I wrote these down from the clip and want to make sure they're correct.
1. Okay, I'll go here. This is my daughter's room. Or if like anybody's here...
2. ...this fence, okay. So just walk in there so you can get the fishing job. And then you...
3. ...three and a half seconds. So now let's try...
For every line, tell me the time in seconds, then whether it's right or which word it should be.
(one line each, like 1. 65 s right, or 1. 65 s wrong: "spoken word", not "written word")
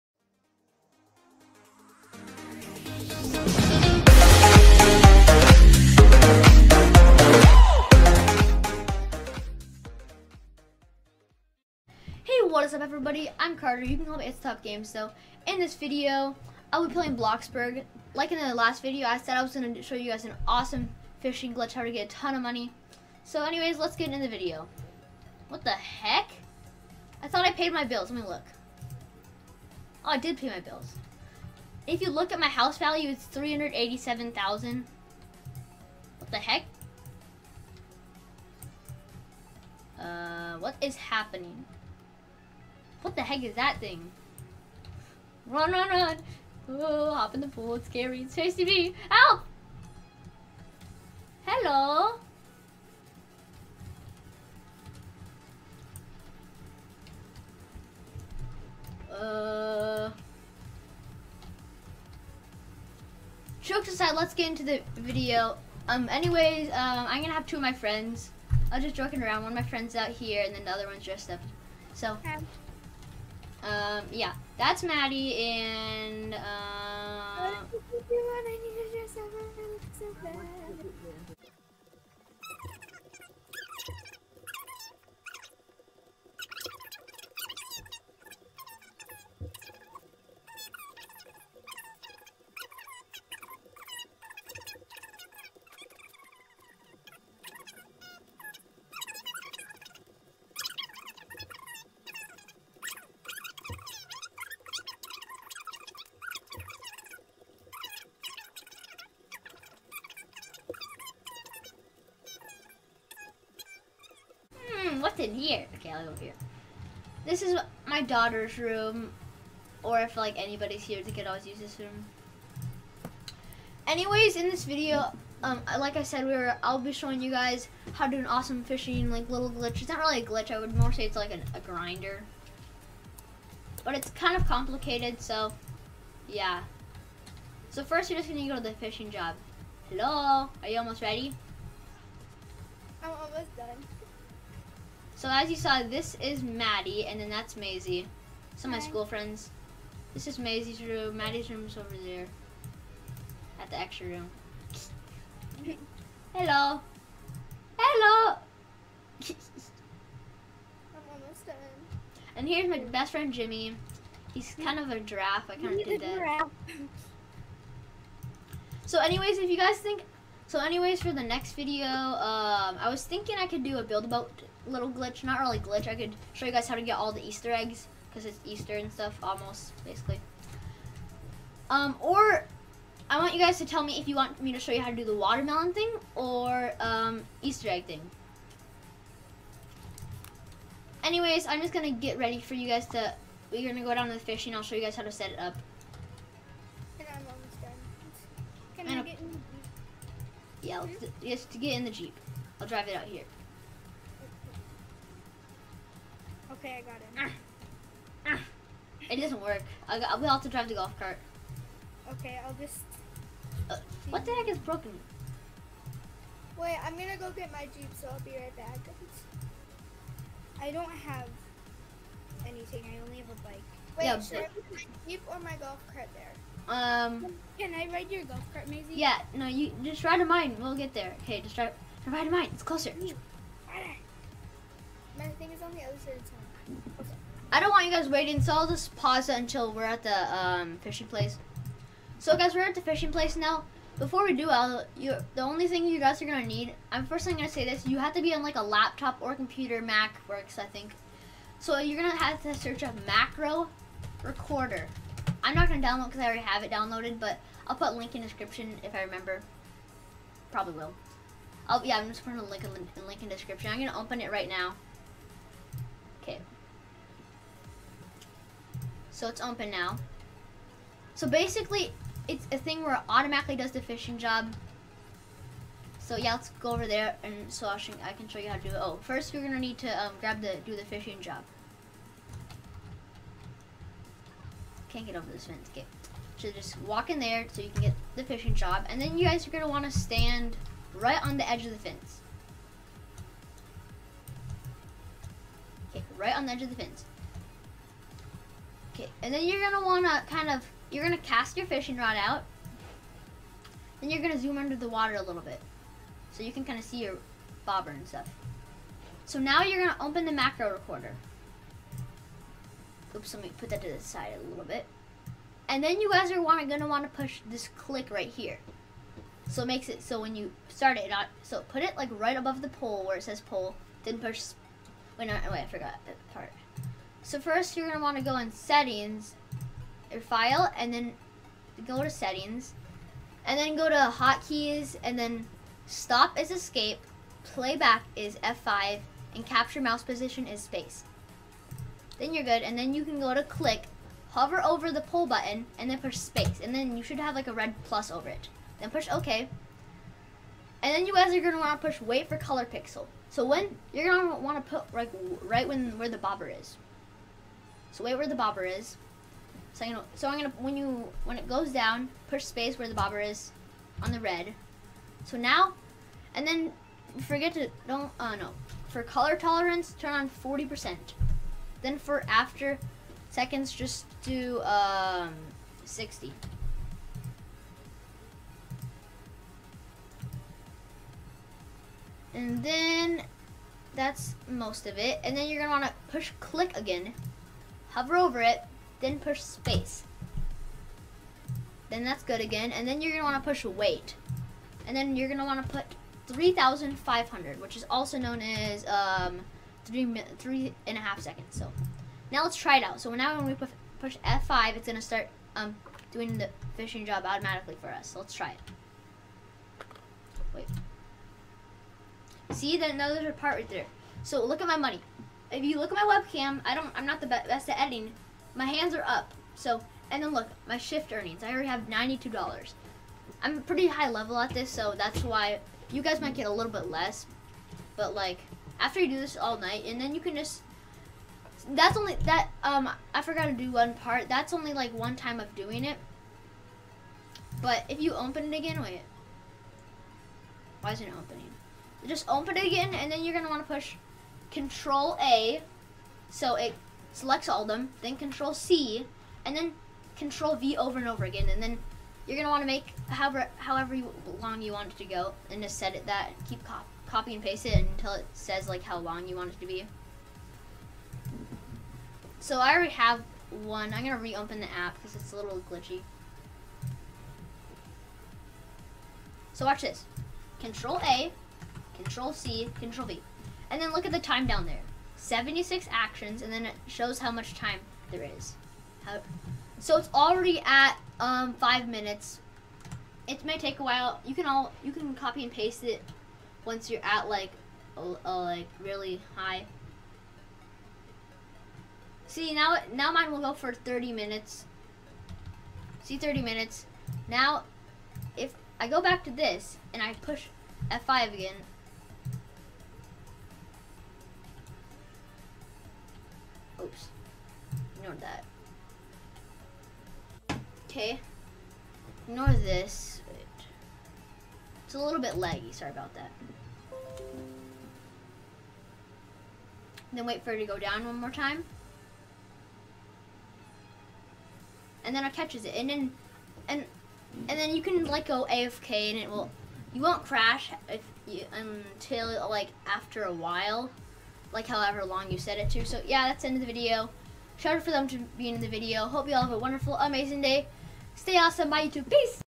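1. 115 s right
2. 285 s right
3. 400 s right.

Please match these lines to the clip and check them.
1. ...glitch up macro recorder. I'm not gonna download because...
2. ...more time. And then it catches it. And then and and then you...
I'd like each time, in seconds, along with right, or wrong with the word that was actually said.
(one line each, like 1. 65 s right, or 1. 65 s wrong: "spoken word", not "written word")
1. 252 s wrong: "search", not "glitch"
2. 521 s right.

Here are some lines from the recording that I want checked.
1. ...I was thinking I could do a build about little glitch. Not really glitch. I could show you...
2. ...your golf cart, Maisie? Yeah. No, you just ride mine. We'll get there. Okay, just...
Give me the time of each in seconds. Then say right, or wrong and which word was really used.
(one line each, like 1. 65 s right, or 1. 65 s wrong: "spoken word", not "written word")
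1. 172 s right
2. 228 s right.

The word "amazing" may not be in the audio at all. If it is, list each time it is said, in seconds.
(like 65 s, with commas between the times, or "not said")
539 s.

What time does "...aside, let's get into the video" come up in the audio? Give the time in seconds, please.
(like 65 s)
63 s.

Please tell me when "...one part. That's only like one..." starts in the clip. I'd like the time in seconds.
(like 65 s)
433 s.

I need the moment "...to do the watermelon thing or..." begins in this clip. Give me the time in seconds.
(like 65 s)
184 s.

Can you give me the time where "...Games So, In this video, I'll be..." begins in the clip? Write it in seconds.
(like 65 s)
14 s.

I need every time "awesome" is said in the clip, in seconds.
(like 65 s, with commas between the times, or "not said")
20 s, 128 s, 541 s.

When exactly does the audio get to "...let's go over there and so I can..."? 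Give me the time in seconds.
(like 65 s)
276 s.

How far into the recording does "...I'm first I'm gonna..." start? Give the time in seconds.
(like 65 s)
246 s.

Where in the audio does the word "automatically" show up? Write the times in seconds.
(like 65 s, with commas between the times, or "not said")
273 s, 407 s.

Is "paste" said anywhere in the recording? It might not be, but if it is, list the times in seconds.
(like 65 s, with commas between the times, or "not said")
457 s, 485 s.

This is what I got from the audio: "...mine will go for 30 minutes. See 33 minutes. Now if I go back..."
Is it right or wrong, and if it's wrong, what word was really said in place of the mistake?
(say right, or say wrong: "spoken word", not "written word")
wrong: "30", not "33".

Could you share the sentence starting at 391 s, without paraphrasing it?
Then that's good again, and then you're gonna wanna push wait.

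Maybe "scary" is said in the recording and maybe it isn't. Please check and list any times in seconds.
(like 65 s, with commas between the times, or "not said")
47 s.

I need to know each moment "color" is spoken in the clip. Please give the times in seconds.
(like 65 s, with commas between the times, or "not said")
352 s, 369 s.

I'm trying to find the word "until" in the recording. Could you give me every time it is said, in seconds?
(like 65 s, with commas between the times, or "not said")
239 s, 457 s, 531 s.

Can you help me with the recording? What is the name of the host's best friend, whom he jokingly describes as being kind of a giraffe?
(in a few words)
Jimmy.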